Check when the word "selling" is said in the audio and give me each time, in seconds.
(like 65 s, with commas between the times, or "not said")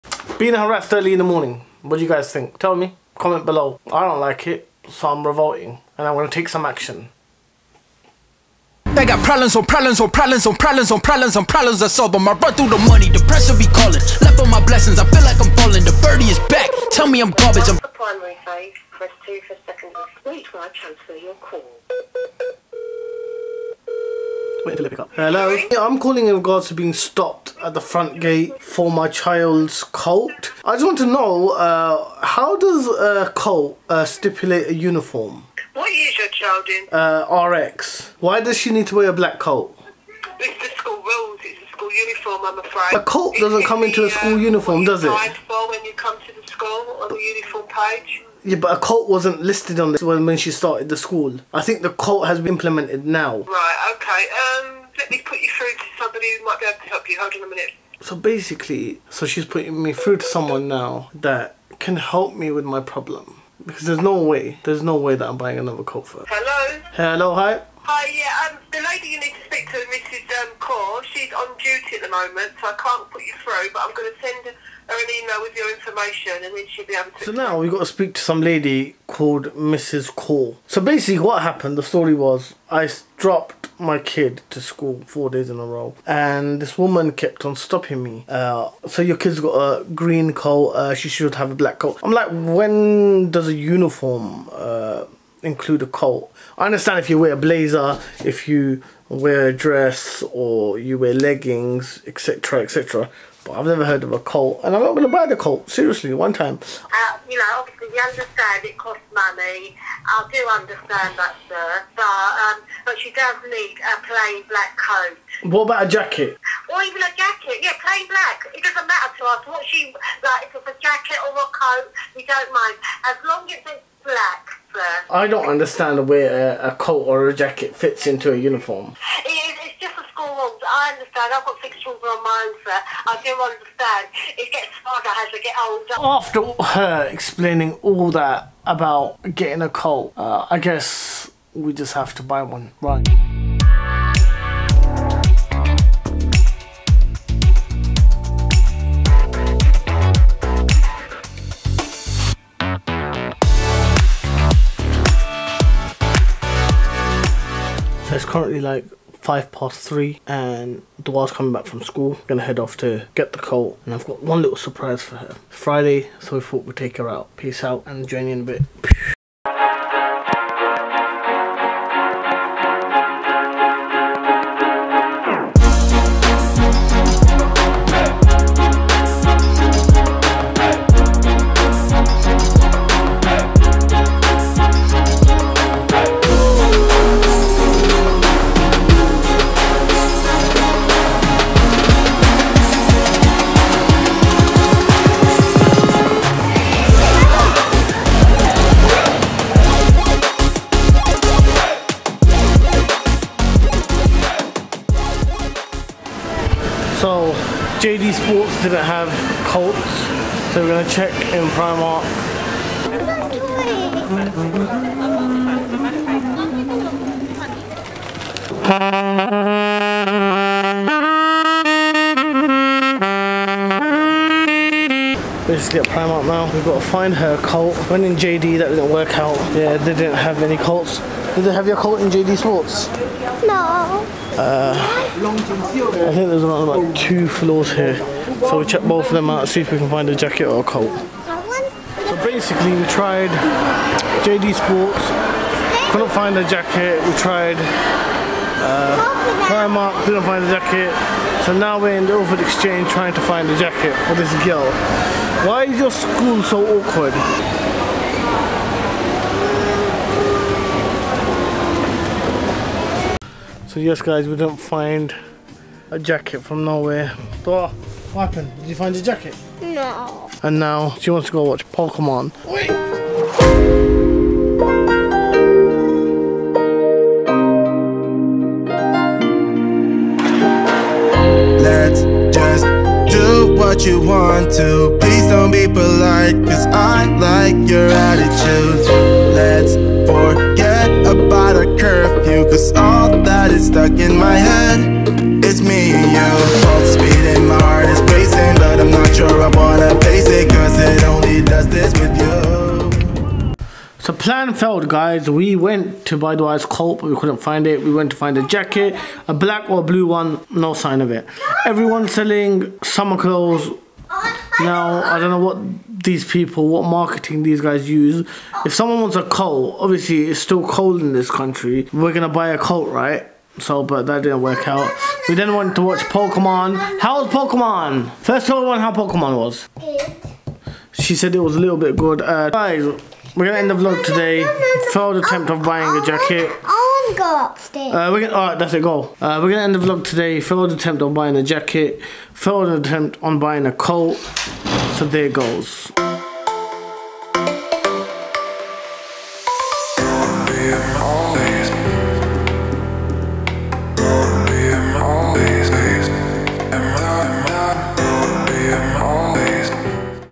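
312 s.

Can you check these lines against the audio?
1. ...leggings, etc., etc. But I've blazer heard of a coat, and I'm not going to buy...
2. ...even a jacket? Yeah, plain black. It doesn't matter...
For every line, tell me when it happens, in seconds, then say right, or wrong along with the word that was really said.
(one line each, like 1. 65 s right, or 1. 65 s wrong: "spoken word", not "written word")
1. 101 s wrong: "never", not "blazer"
2. 116 s right.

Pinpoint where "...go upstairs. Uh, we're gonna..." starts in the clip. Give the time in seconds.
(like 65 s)
337 s.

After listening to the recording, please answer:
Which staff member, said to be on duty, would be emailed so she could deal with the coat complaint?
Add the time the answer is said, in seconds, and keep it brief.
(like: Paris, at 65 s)
Mrs. Core, at 79 s.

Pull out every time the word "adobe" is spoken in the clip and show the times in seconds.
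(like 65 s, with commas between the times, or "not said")
not said.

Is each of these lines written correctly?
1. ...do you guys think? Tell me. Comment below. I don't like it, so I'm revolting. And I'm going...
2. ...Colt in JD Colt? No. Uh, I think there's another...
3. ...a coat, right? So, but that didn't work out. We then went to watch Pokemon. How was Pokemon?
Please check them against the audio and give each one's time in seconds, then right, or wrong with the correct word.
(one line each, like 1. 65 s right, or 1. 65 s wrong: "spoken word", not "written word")
1. 1 s right
2. 231 s wrong: "Sports", not "Colt"
3. 322 s right.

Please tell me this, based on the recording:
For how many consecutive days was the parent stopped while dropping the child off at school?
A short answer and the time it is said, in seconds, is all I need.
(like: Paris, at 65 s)
4, at 85 s.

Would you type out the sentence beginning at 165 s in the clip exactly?
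Friday, so we thought we'd take her out.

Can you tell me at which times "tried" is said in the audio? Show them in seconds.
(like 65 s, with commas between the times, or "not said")
242 s, 247 s.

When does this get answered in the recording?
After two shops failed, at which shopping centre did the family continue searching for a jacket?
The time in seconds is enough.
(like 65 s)
252 s.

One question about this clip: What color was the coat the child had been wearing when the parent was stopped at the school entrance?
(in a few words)
Green.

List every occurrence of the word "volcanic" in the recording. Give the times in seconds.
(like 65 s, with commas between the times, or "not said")
not said.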